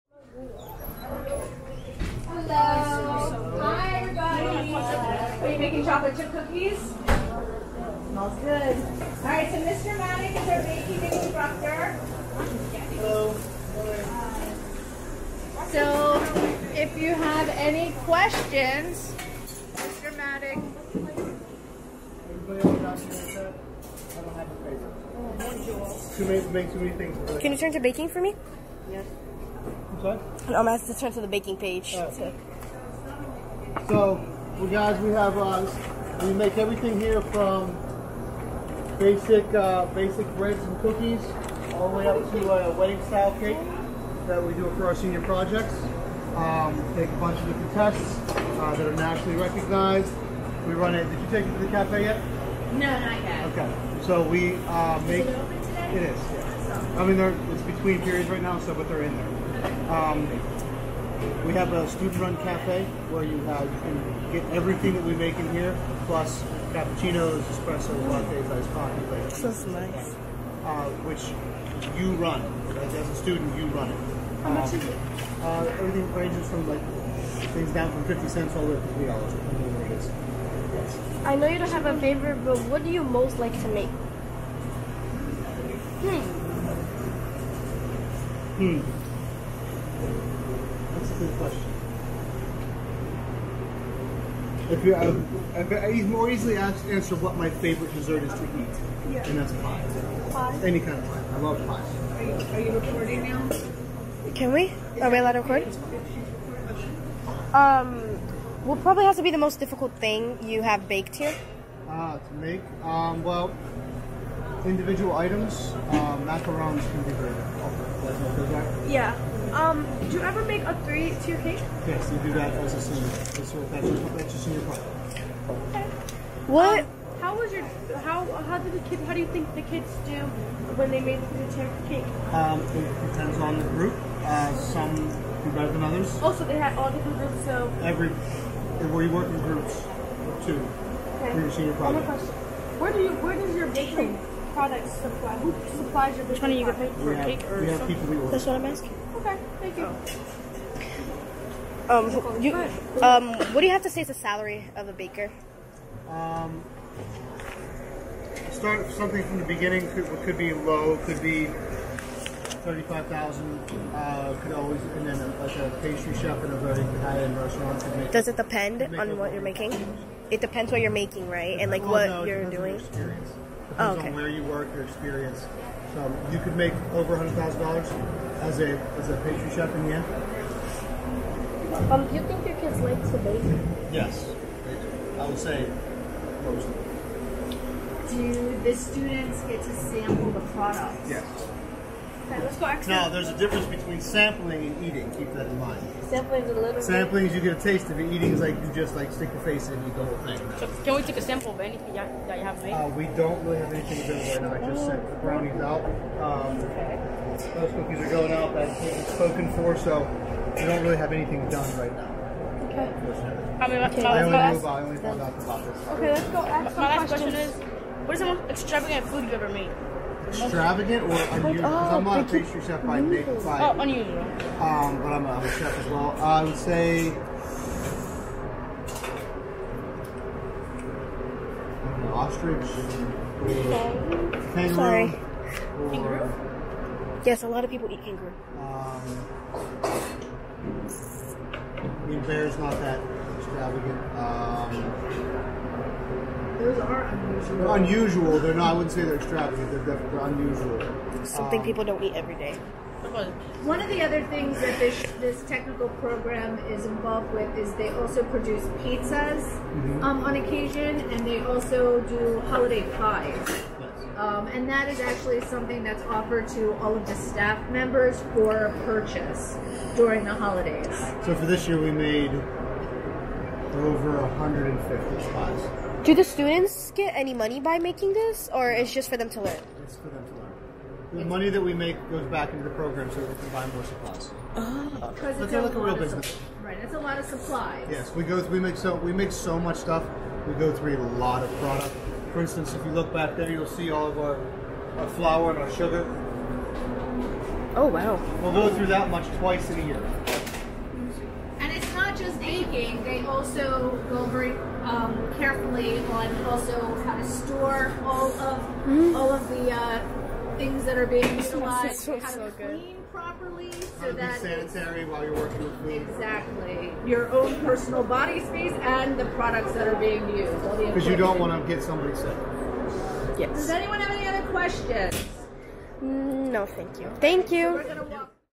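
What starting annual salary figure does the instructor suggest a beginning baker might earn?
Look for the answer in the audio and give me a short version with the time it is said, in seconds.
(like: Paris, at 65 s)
$35,000, at 162 s.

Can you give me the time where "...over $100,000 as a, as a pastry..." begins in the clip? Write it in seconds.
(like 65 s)
176 s.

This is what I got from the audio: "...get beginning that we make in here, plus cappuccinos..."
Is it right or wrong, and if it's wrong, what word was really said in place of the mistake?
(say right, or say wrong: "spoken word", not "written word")
wrong: "everything", not "beginning".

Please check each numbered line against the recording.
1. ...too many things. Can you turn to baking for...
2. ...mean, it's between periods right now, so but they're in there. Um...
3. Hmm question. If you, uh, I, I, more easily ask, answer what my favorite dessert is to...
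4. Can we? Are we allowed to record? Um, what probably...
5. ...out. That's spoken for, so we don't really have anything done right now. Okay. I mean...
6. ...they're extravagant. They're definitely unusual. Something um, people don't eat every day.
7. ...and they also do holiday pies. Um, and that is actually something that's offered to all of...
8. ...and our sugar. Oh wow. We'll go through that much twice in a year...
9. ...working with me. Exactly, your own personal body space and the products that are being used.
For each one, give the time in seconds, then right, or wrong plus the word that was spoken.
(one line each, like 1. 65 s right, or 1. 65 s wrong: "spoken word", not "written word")
1. 26 s right
2. 57 s right
3. 88 s right
4. 104 s right
5. 208 s right
6. 249 s right
7. 261 s right
8. 295 s right
9. 315 s right.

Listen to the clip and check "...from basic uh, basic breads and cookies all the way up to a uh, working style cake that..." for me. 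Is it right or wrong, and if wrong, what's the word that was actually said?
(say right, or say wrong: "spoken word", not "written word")
wrong: "wedding", not "working".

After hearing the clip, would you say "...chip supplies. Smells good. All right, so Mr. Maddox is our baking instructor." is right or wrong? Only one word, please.
wrong.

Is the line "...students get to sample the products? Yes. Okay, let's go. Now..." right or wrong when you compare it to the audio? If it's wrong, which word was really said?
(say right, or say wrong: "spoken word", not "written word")
right.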